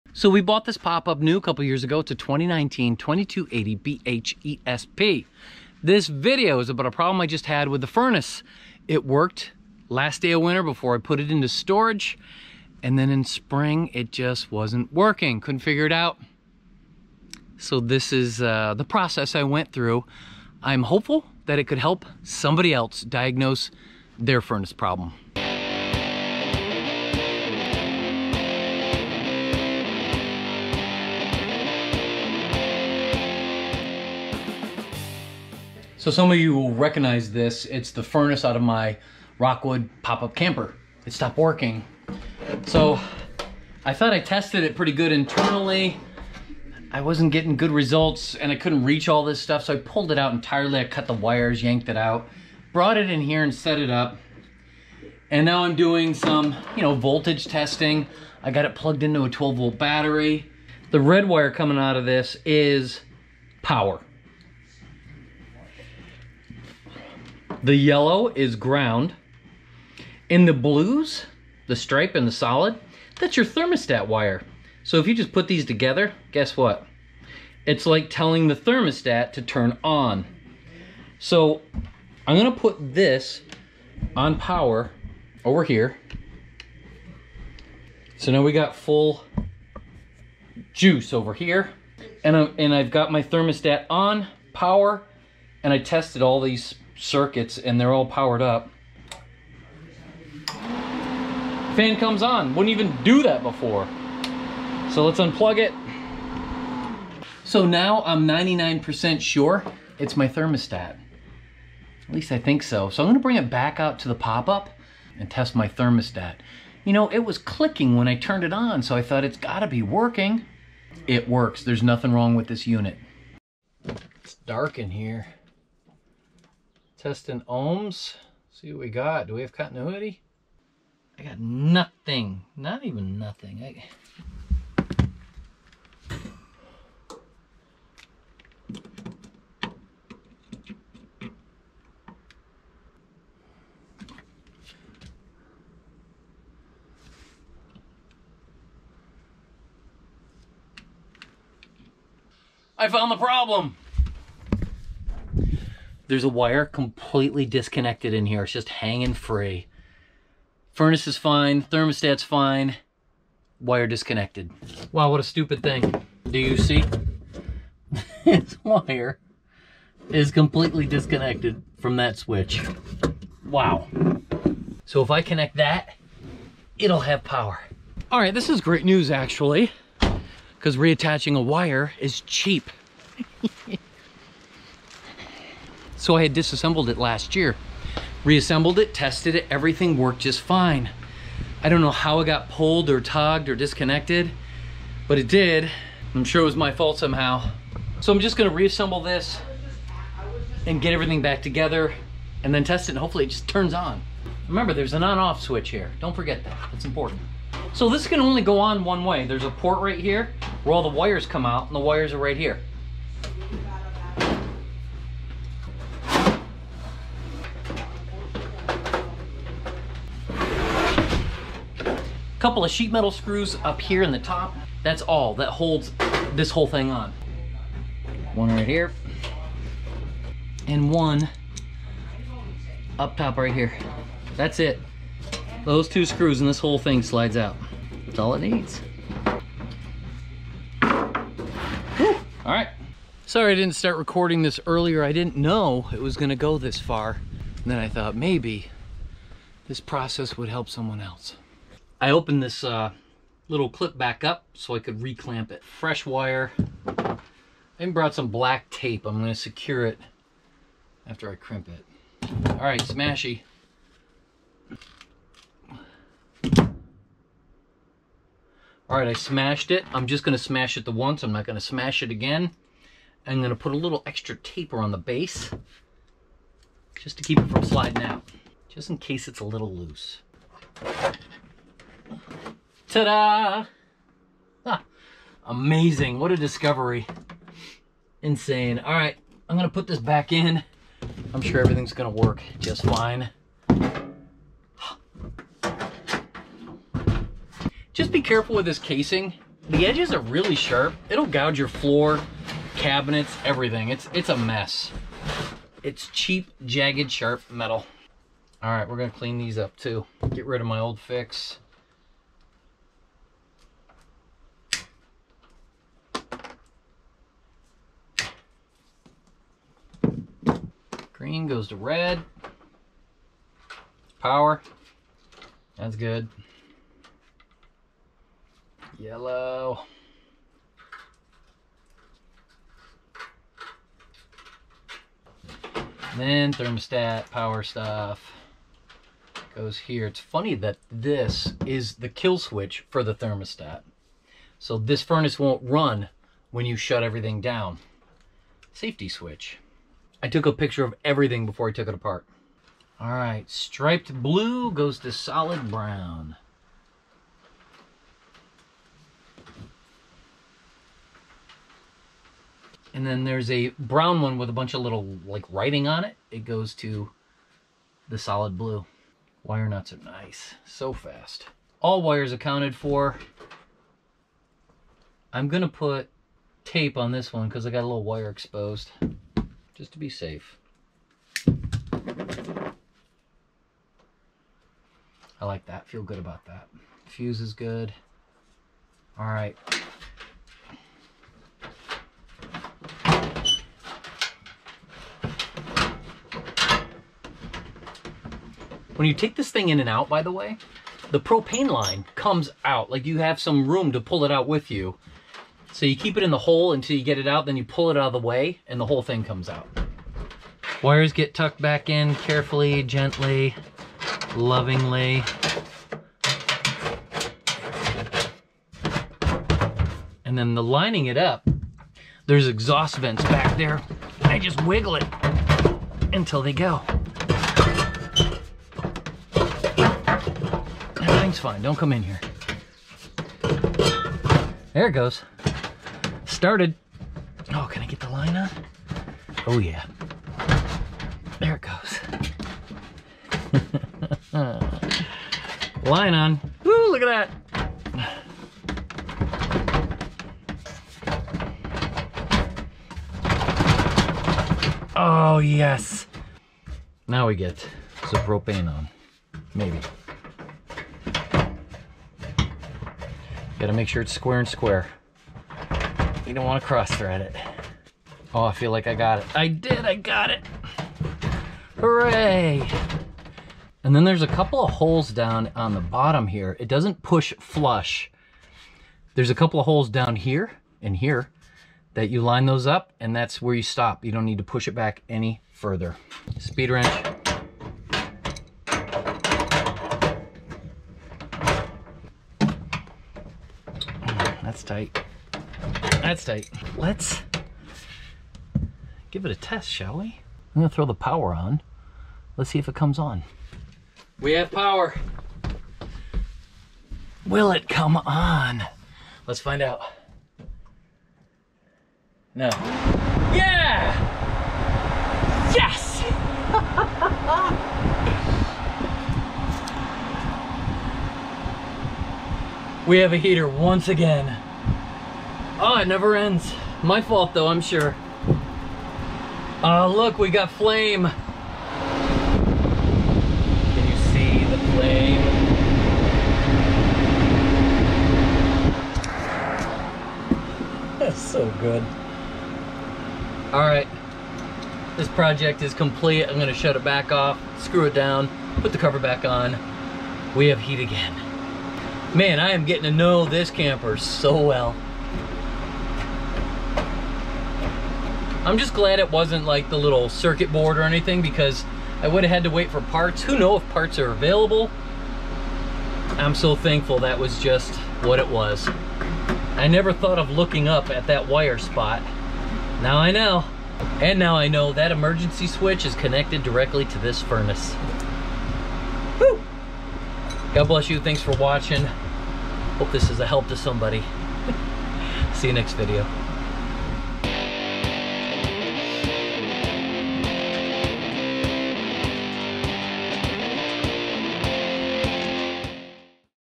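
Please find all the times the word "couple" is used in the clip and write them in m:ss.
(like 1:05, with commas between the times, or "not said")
0:01, 3:42, 7:54, 7:59.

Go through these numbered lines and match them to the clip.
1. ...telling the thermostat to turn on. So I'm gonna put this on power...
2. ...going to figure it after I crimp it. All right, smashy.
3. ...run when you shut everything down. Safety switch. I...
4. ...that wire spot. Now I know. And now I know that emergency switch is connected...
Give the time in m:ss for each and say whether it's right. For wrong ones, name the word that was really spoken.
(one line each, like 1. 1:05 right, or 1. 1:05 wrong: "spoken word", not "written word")
1. 1:18 right
2. 4:19 wrong: "secure", not "figure"
3. 5:45 right
4. 9:31 right.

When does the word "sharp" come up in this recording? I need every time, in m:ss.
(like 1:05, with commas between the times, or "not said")
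5:00, 5:07.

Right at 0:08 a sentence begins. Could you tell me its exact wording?
It worked last day of winter before I put it into storage.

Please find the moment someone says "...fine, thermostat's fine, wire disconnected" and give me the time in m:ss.
2:41.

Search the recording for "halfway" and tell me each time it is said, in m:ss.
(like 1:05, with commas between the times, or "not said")
not said.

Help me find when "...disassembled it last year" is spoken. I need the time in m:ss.
3:06.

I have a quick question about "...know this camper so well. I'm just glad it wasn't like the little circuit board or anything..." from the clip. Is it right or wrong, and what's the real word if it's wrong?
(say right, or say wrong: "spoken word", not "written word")
right.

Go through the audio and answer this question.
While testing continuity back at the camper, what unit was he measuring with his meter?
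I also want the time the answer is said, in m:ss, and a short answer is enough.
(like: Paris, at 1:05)
Ohms, at 2:07.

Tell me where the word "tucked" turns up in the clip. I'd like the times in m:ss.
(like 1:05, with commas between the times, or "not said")
6:51.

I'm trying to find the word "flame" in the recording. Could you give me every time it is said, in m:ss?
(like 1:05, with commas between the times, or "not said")
8:50, 8:54.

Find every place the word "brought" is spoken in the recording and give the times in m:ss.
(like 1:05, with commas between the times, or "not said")
0:52, 4:17.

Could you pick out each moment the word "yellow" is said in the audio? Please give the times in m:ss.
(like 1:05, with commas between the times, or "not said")
1:07, 5:28.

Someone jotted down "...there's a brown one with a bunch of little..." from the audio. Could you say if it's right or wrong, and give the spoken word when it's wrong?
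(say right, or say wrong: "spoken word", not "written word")
right.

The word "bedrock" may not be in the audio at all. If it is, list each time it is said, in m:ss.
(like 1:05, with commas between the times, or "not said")
not said.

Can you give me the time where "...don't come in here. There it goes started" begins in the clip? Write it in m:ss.
7:11.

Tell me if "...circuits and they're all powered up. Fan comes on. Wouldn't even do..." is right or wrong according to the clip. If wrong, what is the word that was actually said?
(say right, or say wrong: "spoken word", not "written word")
right.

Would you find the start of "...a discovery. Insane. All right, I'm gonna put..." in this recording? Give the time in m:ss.
4:46.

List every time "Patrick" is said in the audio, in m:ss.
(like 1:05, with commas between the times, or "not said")
not said.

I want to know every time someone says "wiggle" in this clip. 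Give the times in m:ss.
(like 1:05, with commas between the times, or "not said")
7:04.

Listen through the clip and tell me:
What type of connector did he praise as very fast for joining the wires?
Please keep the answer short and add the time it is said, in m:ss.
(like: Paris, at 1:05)
Wire nuts, at 6:09.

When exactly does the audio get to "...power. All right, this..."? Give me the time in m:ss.
2:57.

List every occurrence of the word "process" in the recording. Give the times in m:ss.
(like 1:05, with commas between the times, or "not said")
0:18, 4:09.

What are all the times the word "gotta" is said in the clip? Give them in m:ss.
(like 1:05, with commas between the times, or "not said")
1:59, 7:43.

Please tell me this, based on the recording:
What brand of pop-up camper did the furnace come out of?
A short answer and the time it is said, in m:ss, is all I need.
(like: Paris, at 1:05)
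Rockwood, at 0:39.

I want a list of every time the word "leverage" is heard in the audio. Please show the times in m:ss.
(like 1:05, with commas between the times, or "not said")
not said.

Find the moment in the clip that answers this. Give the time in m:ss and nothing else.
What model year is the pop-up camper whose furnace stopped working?
0:02.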